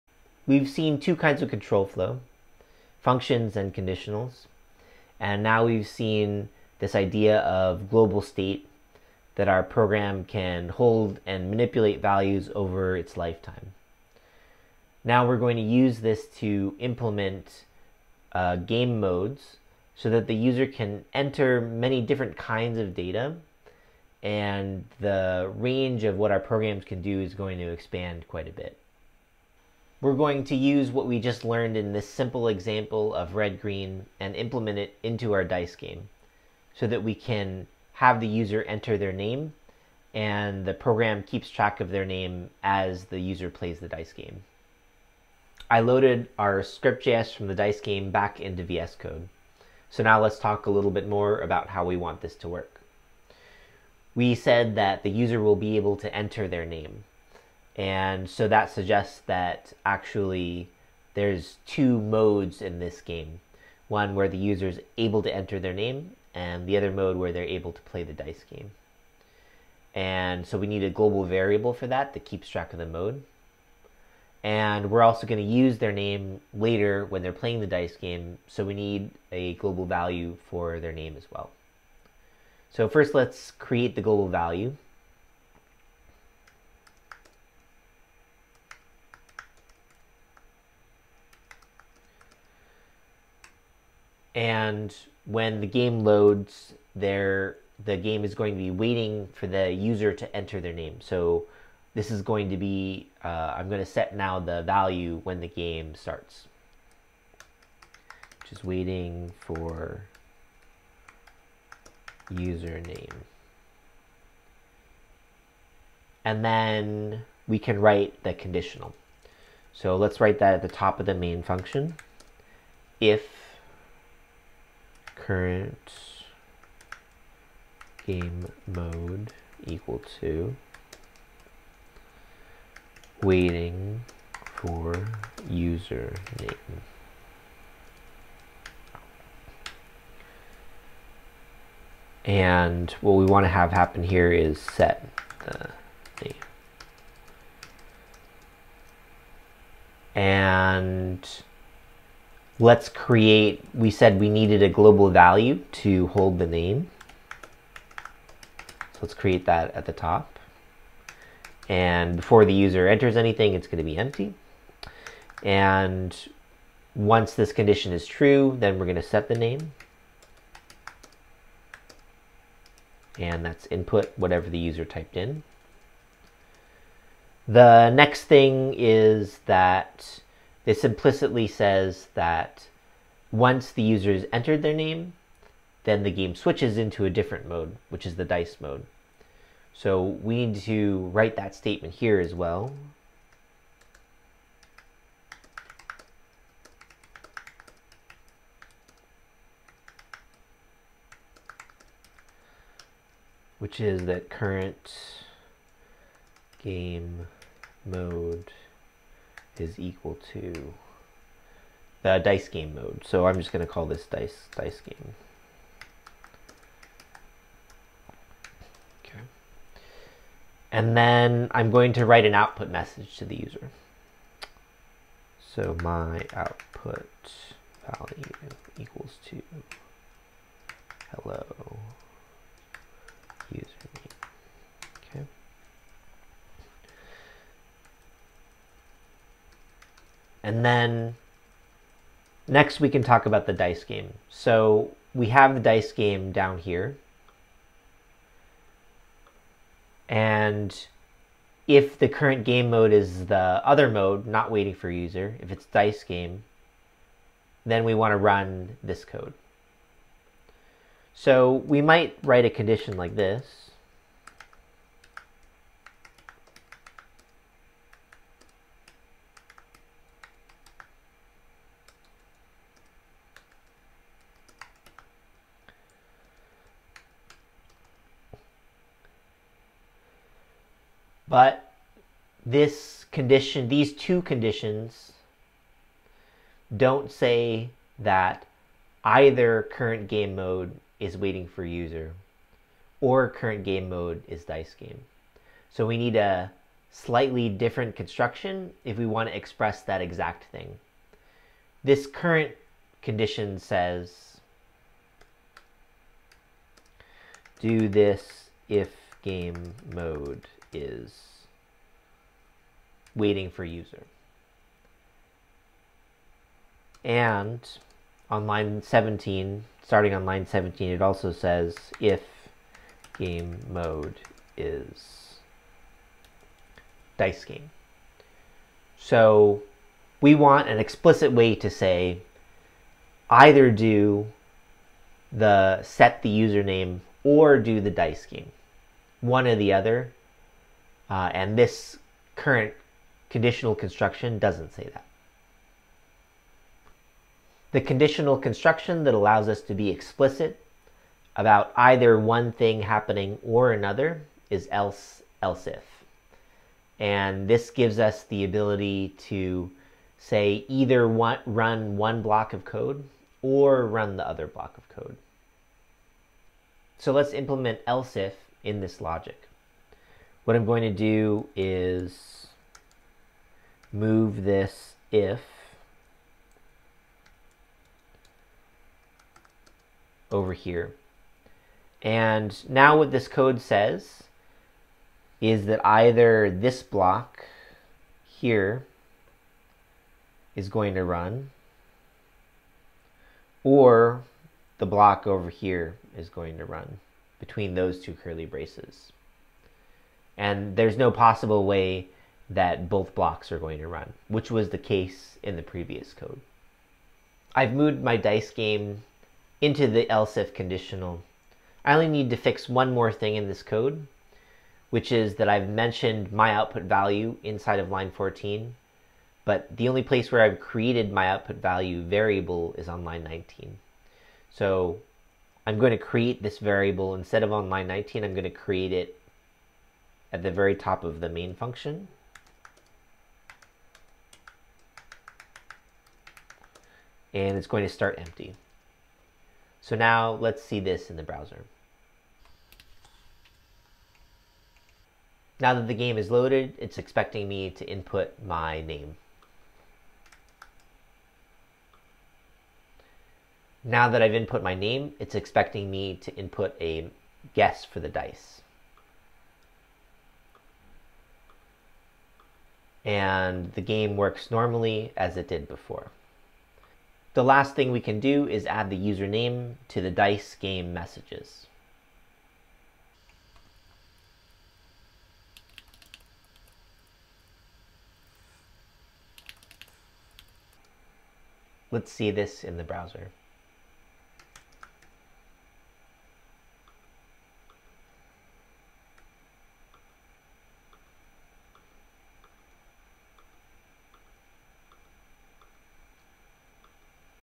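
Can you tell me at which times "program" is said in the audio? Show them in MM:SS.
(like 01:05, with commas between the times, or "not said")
00:09, 00:26, 00:40.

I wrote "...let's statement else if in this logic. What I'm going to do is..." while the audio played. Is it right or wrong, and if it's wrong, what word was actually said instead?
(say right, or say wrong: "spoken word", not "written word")
wrong: "implement", not "statement".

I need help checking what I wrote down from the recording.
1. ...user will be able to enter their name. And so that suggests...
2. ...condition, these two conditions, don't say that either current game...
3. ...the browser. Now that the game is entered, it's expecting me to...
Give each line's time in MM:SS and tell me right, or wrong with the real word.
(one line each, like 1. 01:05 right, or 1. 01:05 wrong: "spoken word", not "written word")
1. 00:55 right
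2. 04:43 right
3. 07:21 wrong: "loaded", not "entered".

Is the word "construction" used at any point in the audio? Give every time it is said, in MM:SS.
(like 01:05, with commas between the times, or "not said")
04:57, 05:43, 05:48.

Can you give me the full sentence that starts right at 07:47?
The last thing we can do is add the username to the dice game messages.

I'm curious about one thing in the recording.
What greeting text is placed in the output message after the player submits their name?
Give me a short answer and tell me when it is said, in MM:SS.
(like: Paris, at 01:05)
hello user, at 03:51.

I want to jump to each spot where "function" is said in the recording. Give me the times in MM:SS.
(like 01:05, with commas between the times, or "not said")
00:02, 02:01, 07:11.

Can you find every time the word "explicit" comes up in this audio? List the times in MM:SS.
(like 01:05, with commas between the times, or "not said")
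05:30, 05:49.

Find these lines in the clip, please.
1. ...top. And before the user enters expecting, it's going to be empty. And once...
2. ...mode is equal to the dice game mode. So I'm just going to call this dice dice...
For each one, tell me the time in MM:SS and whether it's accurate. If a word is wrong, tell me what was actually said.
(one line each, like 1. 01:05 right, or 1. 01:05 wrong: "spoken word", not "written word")
1. 02:39 wrong: "anything", not "expecting"
2. 03:27 right.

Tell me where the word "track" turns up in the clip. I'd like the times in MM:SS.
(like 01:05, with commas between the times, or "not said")
00:41, 01:12.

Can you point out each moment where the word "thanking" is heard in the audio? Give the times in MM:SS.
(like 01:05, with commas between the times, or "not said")
not said.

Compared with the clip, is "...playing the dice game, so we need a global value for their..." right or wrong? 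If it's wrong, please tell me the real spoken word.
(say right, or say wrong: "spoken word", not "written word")
right.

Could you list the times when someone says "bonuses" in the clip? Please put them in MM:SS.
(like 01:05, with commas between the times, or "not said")
not said.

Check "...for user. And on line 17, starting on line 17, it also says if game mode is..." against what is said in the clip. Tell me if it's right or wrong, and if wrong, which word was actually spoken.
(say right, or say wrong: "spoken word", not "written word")
right.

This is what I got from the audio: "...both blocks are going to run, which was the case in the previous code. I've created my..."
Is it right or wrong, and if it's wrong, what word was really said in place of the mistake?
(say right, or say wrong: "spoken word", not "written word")
wrong: "moved", not "created".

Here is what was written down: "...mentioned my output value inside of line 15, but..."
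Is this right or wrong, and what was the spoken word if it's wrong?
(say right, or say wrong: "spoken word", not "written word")
wrong: "14", not "15".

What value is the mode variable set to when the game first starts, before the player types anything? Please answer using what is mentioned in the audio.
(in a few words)
waiting for username.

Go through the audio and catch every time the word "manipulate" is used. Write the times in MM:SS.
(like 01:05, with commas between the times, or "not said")
00:11.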